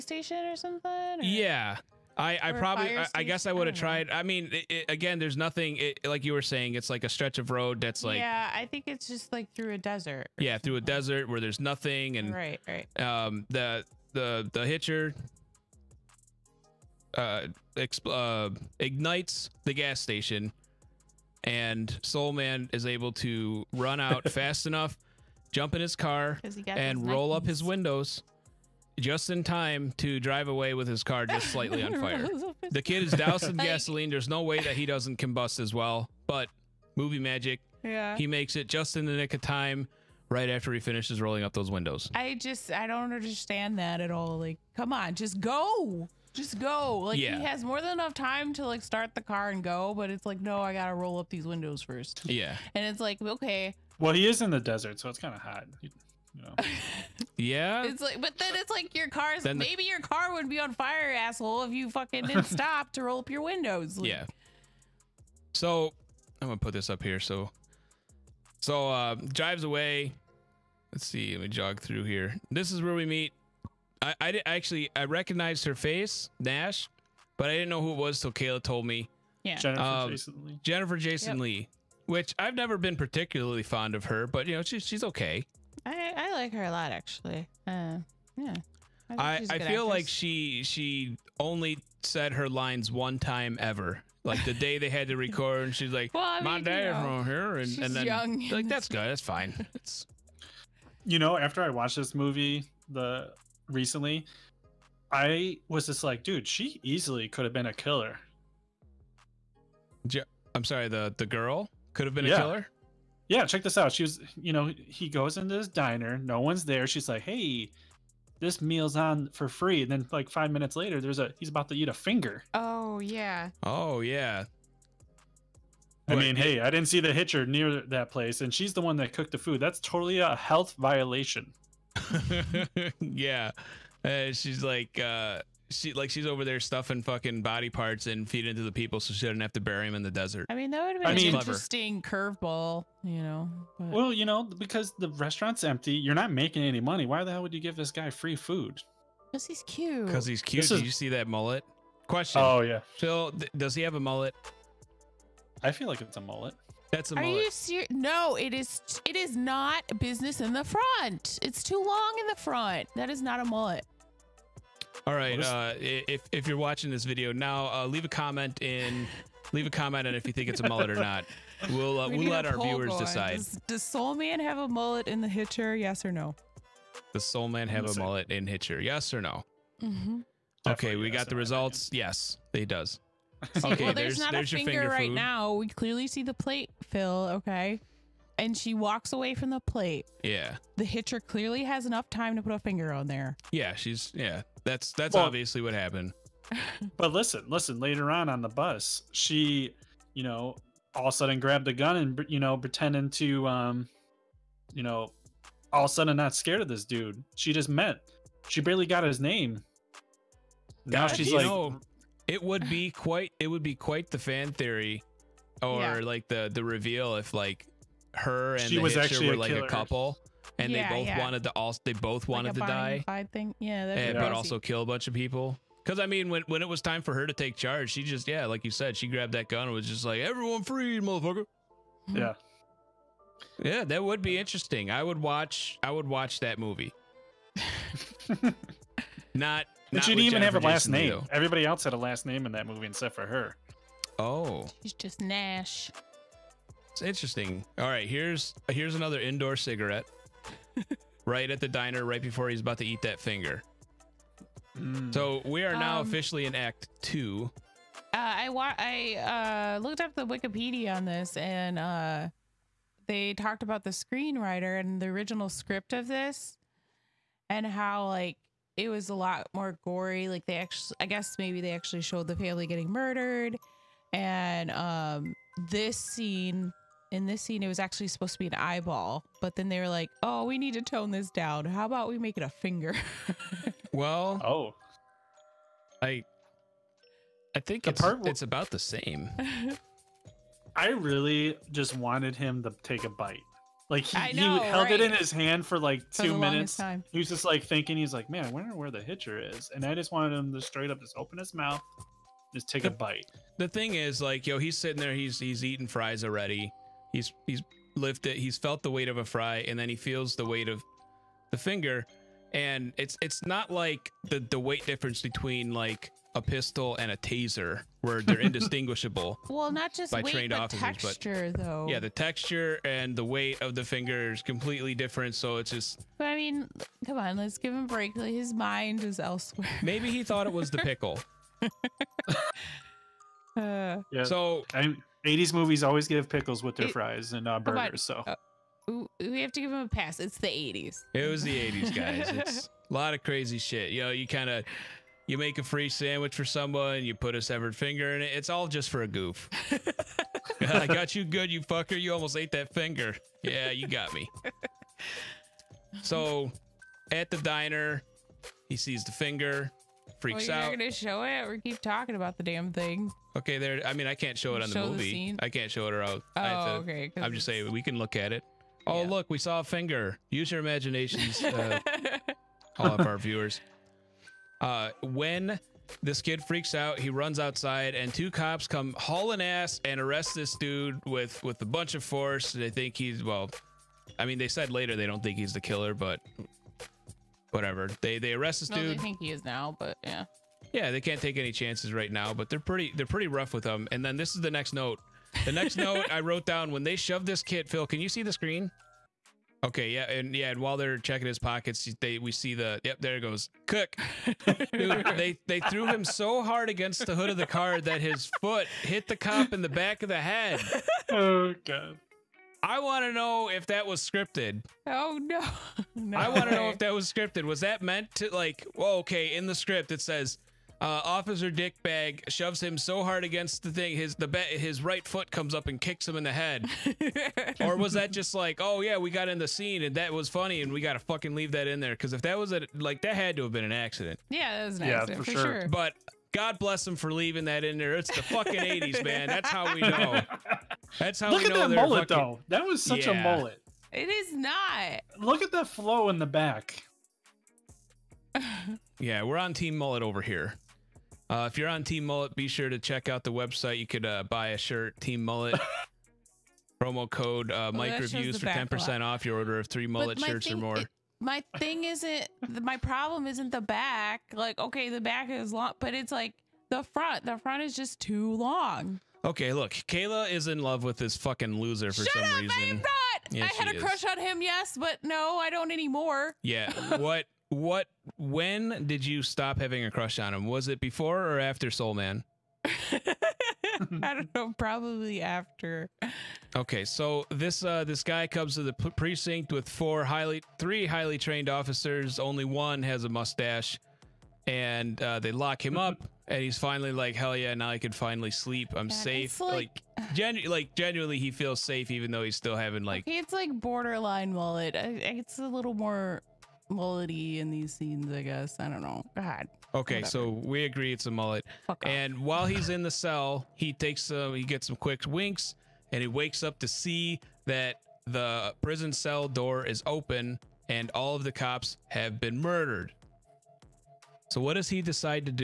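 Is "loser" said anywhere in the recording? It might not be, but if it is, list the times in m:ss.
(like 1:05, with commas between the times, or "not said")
7:51.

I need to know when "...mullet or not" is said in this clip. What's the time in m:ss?
2:50.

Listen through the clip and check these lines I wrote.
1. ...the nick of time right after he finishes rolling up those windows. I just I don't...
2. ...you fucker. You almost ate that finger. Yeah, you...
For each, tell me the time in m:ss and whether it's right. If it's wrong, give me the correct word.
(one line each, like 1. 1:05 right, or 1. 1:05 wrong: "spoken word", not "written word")
1. 0:39 right
2. 5:51 right.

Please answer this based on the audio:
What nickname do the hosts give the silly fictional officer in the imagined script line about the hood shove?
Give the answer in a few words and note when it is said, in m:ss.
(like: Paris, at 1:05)
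Officer Dickbag, at 7:01.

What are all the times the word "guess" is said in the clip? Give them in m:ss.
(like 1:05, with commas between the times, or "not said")
0:03, 4:31, 8:28.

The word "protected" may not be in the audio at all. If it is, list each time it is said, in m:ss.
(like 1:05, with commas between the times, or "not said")
not said.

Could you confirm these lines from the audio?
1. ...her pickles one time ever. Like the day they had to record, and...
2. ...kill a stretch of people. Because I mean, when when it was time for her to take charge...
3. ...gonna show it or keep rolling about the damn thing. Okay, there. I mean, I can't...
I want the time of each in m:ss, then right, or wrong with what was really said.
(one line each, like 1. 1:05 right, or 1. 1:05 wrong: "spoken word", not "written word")
1. 1:32 wrong: "lines", not "pickles"
2. 3:44 wrong: "bunch", not "stretch"
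3. 6:00 wrong: "talking", not "rolling".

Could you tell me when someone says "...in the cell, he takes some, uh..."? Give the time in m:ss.
8:32.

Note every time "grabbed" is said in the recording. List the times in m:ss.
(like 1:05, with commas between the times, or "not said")
3:21, 3:49.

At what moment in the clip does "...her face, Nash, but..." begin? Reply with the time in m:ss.
1:15.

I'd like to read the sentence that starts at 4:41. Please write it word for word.
How about we make it a finger?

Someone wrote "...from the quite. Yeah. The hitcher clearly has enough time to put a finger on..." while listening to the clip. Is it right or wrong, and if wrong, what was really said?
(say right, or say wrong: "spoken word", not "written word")
wrong: "plate", not "quite".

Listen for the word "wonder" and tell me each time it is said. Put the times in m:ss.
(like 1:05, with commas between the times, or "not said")
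4:58.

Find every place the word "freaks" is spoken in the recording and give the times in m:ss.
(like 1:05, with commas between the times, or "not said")
6:00, 6:16.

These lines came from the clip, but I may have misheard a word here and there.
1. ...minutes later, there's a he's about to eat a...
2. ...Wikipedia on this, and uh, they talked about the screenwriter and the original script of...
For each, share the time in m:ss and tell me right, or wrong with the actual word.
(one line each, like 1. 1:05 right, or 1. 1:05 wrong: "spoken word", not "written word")
1. 2:00 right
2. 4:20 right.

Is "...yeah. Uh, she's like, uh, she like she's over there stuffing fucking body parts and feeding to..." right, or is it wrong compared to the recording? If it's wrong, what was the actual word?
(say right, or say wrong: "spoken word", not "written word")
right.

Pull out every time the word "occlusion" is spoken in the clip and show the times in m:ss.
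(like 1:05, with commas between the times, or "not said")
not said.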